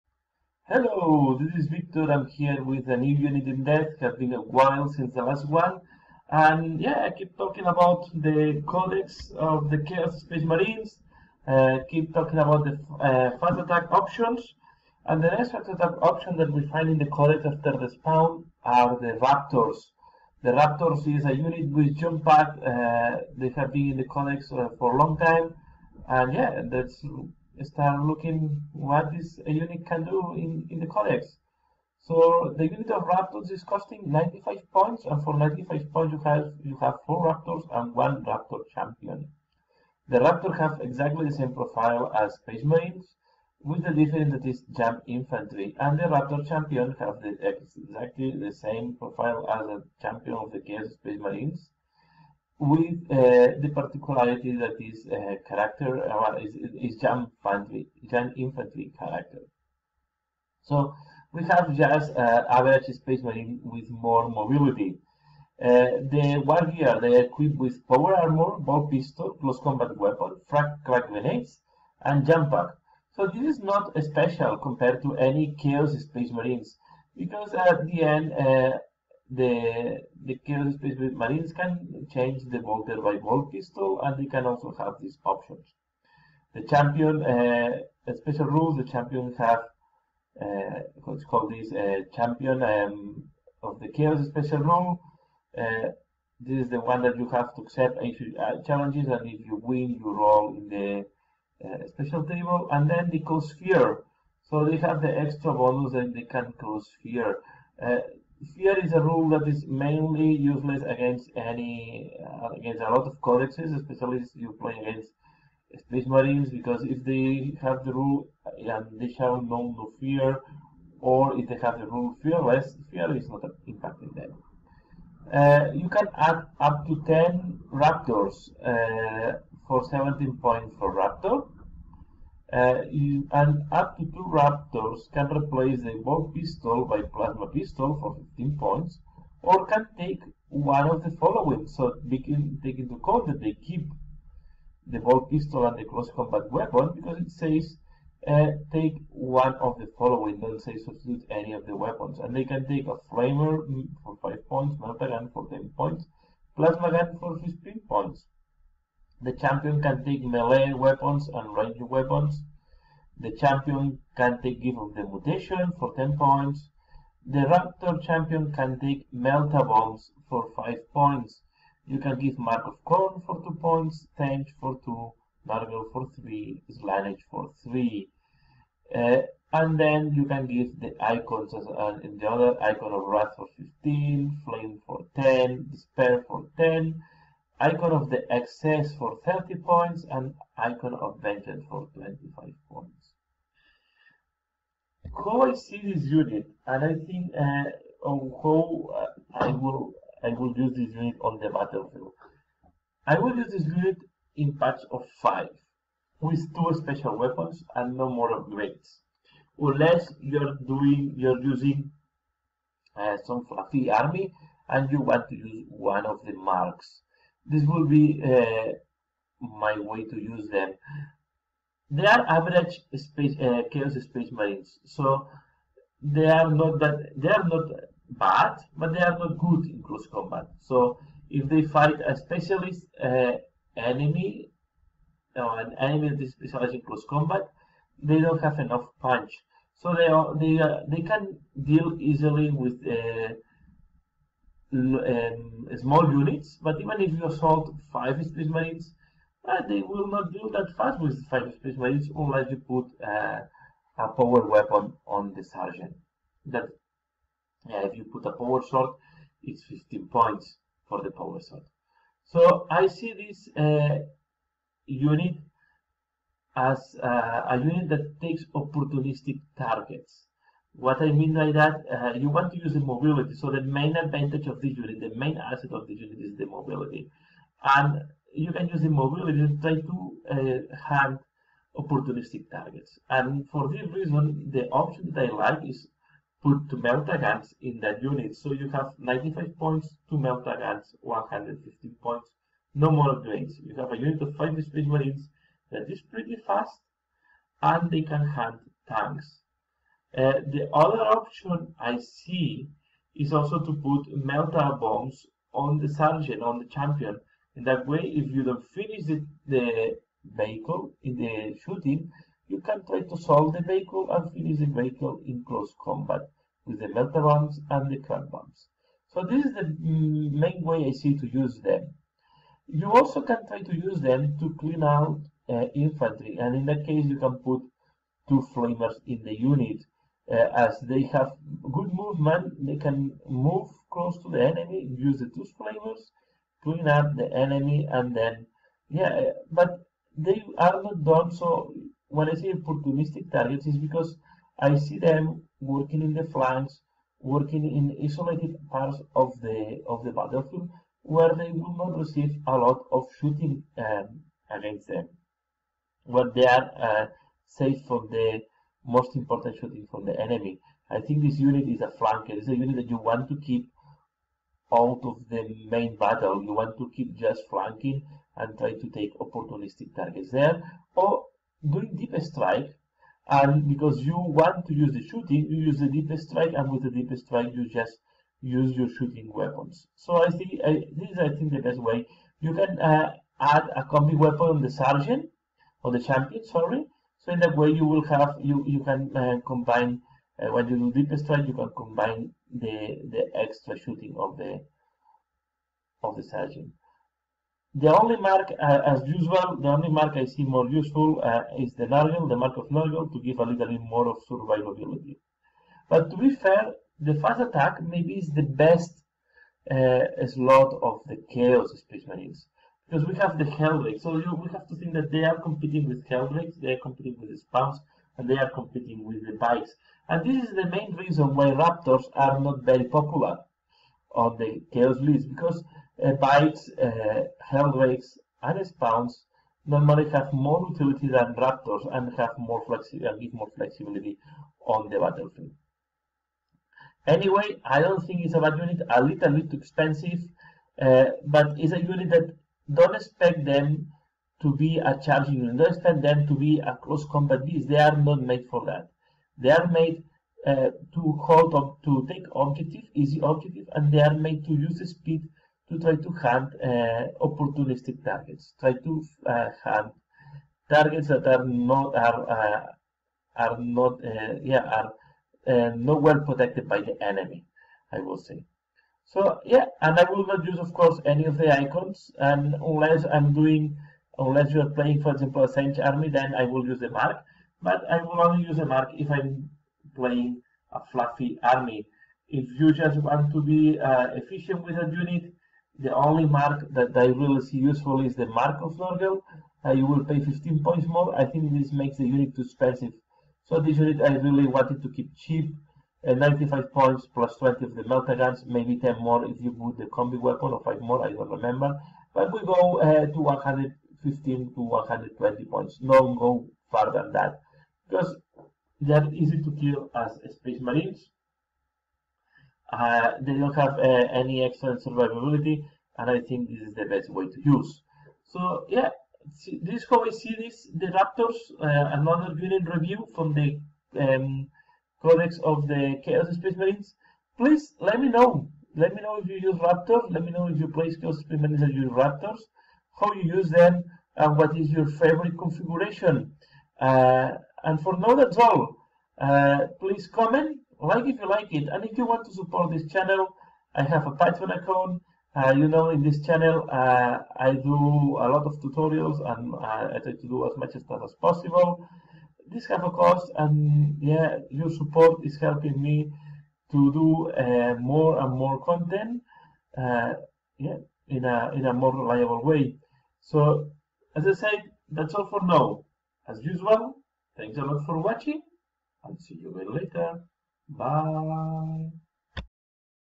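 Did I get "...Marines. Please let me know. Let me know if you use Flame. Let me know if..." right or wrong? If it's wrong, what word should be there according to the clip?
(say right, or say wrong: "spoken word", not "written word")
wrong: "Raptors", not "Flame".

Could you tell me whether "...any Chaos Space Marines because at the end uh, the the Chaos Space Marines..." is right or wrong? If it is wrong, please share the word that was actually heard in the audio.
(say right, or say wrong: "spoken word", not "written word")
right.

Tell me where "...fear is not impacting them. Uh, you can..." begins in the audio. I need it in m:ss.
2:02.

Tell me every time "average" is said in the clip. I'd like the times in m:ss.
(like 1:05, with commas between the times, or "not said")
1:02, 3:42.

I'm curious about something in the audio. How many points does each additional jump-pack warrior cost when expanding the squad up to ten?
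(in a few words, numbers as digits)
17 points.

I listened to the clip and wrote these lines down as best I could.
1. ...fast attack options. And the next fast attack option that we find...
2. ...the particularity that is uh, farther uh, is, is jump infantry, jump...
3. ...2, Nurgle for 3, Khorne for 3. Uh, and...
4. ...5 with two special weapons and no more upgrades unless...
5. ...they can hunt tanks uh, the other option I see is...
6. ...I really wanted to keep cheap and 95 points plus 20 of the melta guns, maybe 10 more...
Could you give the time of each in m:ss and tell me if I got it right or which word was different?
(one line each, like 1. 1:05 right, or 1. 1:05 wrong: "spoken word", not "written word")
1. 0:13 right
2. 0:53 wrong: "character", not "farther"
3. 2:54 wrong: "Slaanesh", not "Khorne"
4. 3:25 right
5. 4:57 right
6. 8:14 right.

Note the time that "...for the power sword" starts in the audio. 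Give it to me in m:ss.
4:20.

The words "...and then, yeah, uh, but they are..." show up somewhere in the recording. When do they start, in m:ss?
5:37.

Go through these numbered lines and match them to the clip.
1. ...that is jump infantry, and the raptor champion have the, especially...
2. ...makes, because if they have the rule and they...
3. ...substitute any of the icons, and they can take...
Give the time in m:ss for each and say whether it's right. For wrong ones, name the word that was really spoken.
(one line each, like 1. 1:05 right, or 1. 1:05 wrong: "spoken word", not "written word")
1. 0:44 wrong: "exactly", not "especially"
2. 1:56 wrong: "marines", not "makes"
3. 2:30 wrong: "weapons", not "icons".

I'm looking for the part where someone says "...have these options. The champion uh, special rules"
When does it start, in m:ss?
1:24.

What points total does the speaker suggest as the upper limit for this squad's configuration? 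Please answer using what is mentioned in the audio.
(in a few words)
120 points.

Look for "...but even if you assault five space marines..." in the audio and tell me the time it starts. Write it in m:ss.
4:06.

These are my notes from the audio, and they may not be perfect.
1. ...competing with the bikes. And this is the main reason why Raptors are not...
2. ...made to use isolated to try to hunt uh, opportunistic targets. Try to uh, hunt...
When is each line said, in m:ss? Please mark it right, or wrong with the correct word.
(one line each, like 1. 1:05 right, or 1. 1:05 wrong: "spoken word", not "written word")
1. 6:58 right
2. 7:34 wrong: "speed", not "isolated".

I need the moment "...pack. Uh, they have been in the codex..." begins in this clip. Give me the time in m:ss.
0:22.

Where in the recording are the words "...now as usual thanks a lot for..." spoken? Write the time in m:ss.
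9:25.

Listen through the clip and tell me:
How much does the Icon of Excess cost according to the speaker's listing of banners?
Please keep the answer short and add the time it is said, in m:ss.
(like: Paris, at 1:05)
30 points, at 3:09.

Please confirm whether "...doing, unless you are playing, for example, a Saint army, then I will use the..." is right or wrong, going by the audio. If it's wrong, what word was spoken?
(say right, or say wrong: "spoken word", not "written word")
right.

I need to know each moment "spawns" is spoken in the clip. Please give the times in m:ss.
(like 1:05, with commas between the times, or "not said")
0:17, 6:57, 7:08.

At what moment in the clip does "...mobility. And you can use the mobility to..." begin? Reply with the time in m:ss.
4:36.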